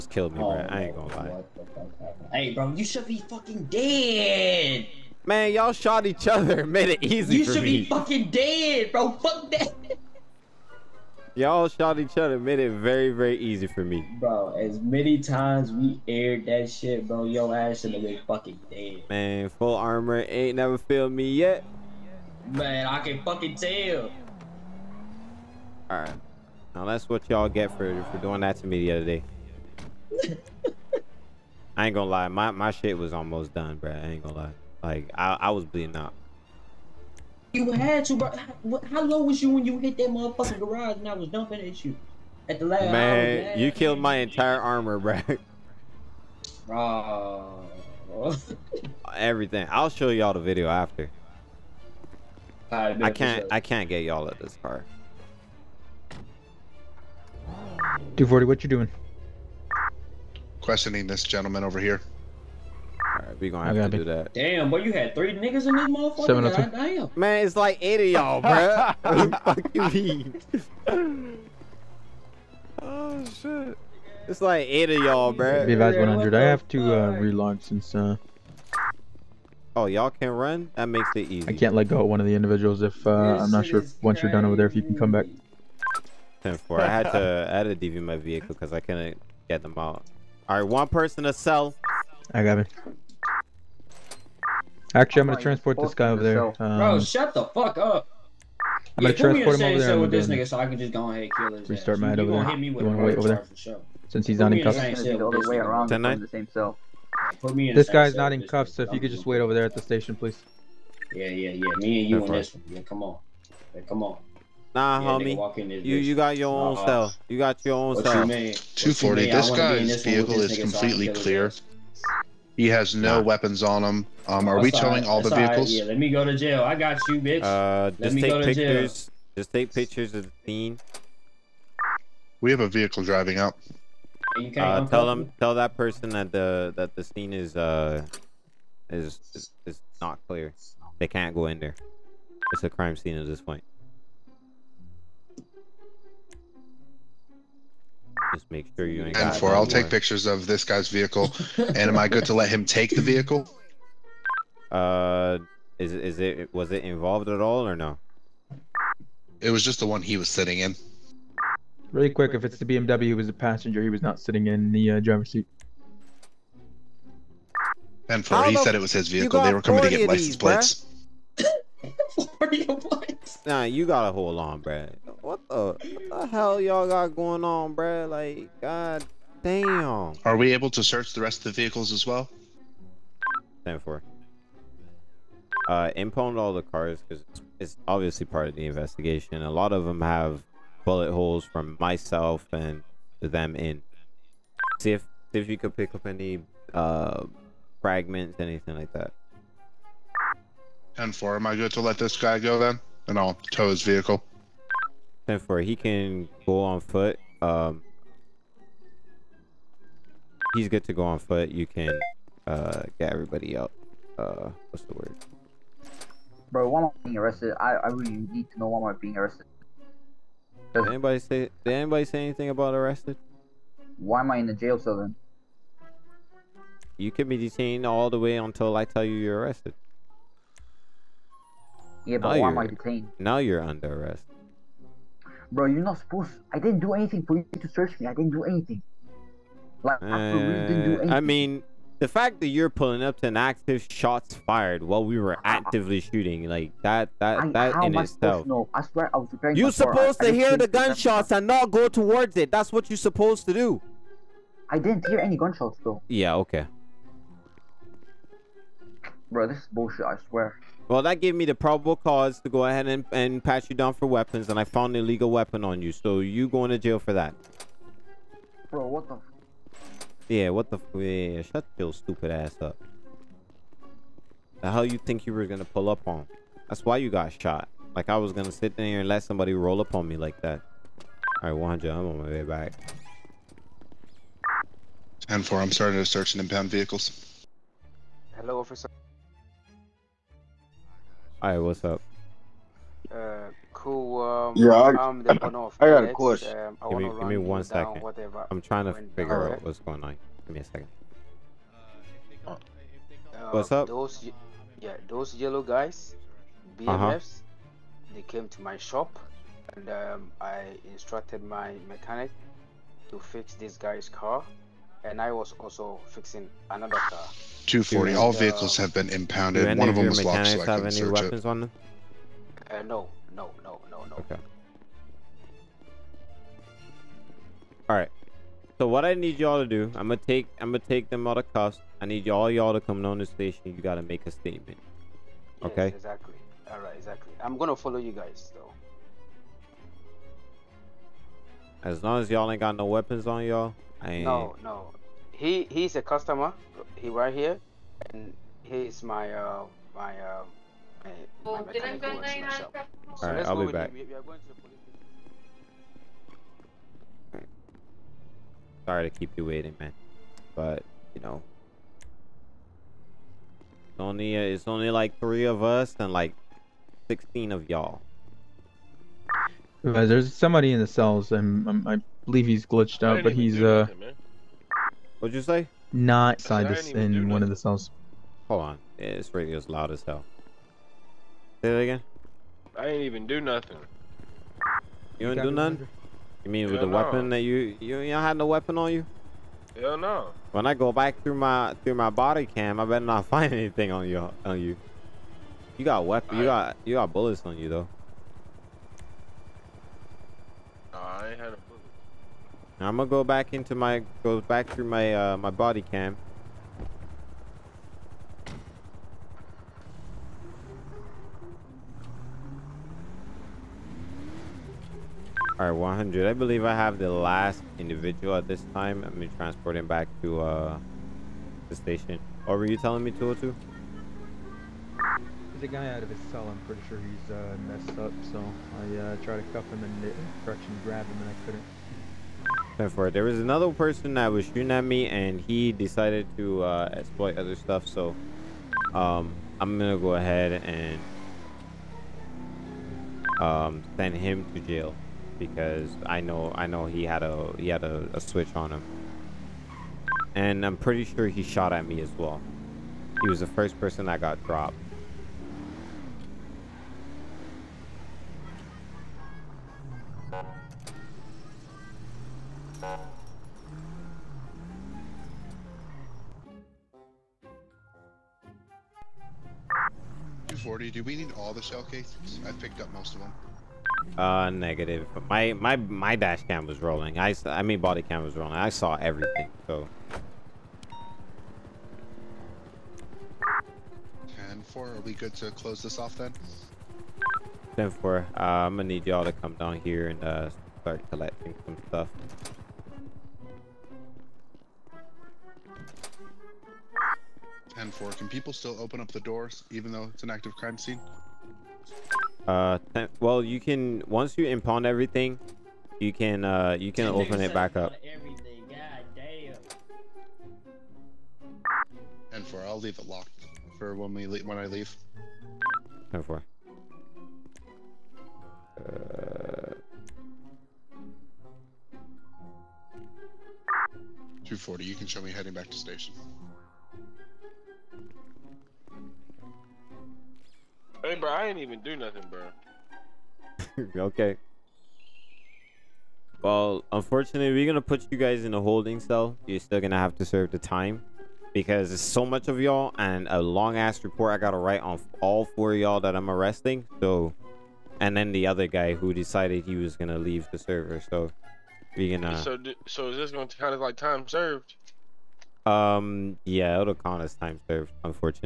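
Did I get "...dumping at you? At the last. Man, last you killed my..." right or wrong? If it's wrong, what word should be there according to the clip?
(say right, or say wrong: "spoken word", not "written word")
right.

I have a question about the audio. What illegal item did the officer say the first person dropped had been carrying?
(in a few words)
A switch.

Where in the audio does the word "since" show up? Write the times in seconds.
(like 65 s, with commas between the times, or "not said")
77 s, 104 s.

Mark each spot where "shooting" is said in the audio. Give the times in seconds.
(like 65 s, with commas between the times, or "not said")
246 s, 434 s.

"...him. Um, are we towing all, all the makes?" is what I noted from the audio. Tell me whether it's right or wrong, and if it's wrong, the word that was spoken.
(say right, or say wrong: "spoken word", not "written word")
wrong: "vehicles", not "makes".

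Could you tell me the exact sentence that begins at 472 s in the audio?
I picked up most of them.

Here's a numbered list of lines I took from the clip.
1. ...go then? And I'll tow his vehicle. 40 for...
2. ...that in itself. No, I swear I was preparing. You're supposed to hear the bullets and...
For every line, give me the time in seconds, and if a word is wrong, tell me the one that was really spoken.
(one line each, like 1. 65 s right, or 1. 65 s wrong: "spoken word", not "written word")
1. 202 s wrong: "10", not "40"
2. 247 s wrong: "gunshots", not "bullets".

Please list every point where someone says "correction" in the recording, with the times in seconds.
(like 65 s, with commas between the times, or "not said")
430 s.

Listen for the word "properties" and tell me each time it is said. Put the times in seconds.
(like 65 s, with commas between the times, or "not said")
not said.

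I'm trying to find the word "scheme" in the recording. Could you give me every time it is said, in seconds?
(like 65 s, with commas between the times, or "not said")
not said.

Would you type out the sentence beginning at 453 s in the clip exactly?
He was the first person that got dropped.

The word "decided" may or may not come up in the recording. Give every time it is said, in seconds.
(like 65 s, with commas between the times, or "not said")
435 s, 549 s.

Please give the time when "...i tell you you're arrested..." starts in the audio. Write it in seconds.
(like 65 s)
228 s.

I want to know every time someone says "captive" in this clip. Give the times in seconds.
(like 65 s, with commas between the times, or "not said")
not said.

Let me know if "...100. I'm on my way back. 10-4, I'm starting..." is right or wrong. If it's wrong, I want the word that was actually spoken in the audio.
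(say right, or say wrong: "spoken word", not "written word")
right.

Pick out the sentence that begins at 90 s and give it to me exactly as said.
All right, one person to sell.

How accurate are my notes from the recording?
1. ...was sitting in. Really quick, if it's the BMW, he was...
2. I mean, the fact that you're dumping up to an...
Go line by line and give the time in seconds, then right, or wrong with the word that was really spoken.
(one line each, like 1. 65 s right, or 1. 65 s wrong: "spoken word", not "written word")
1. 160 s right
2. 241 s wrong: "pulling", not "dumping".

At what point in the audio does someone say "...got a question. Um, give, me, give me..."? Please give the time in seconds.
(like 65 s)
295 s.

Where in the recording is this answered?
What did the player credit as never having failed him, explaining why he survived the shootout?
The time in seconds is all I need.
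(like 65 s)
19 s.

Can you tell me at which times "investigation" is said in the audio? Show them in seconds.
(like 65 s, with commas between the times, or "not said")
188 s.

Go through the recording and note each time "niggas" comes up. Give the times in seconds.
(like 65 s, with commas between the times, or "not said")
65 s, 100 s.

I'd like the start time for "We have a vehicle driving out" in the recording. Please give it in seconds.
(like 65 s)
132 s.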